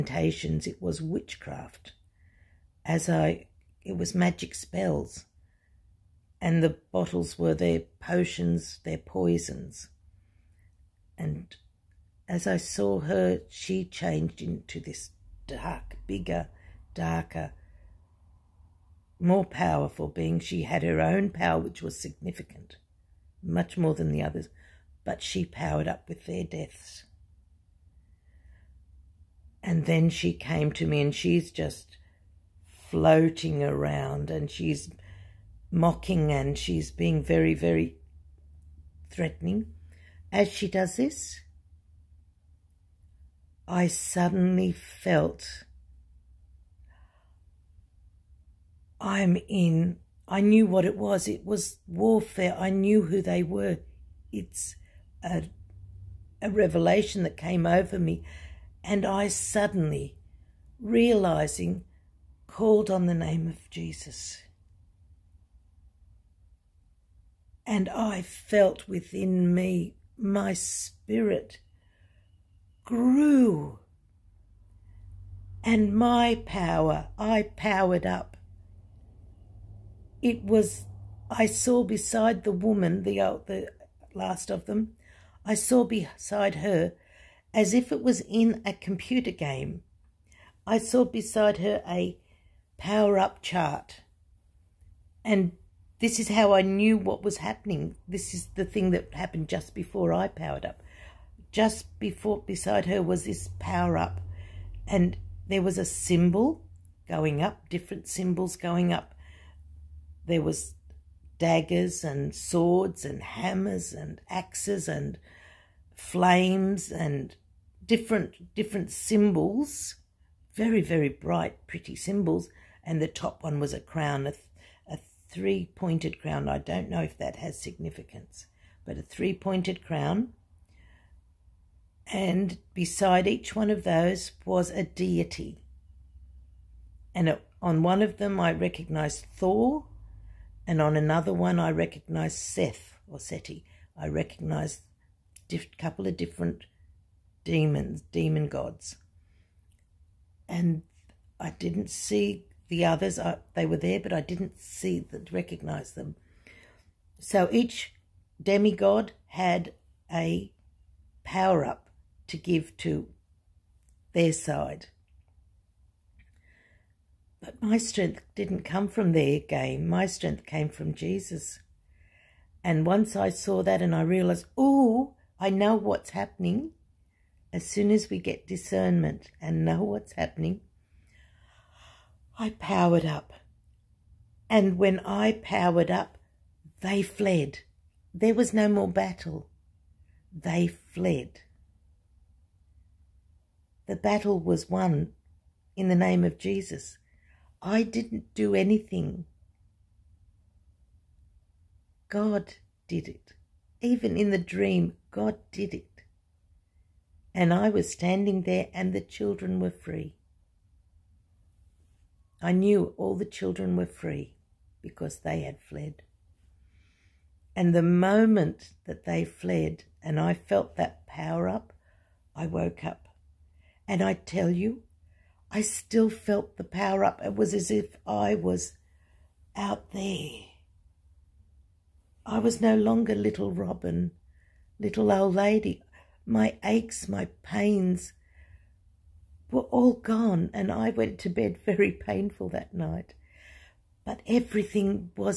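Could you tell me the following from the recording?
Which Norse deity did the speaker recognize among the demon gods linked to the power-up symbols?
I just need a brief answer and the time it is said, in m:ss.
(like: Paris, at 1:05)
Thor, at 2:19.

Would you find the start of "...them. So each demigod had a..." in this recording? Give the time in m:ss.
2:35.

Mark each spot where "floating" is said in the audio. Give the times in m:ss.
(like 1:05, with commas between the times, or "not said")
0:32.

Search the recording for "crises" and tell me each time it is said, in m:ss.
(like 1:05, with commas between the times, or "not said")
not said.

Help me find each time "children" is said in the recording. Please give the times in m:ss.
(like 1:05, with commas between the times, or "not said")
3:28, 3:33.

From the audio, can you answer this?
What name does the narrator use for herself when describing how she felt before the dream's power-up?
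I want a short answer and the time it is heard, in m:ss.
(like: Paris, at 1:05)
Little Robin, at 3:53.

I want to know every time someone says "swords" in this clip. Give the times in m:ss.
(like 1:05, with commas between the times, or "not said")
1:52.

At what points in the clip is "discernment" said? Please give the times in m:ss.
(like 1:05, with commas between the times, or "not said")
2:58.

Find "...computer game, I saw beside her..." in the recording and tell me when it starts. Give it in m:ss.
1:28.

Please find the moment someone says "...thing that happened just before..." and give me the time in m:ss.
1:38.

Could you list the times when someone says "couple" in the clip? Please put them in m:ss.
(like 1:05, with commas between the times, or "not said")
2:25.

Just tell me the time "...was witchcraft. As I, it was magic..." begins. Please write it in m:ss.
0:00.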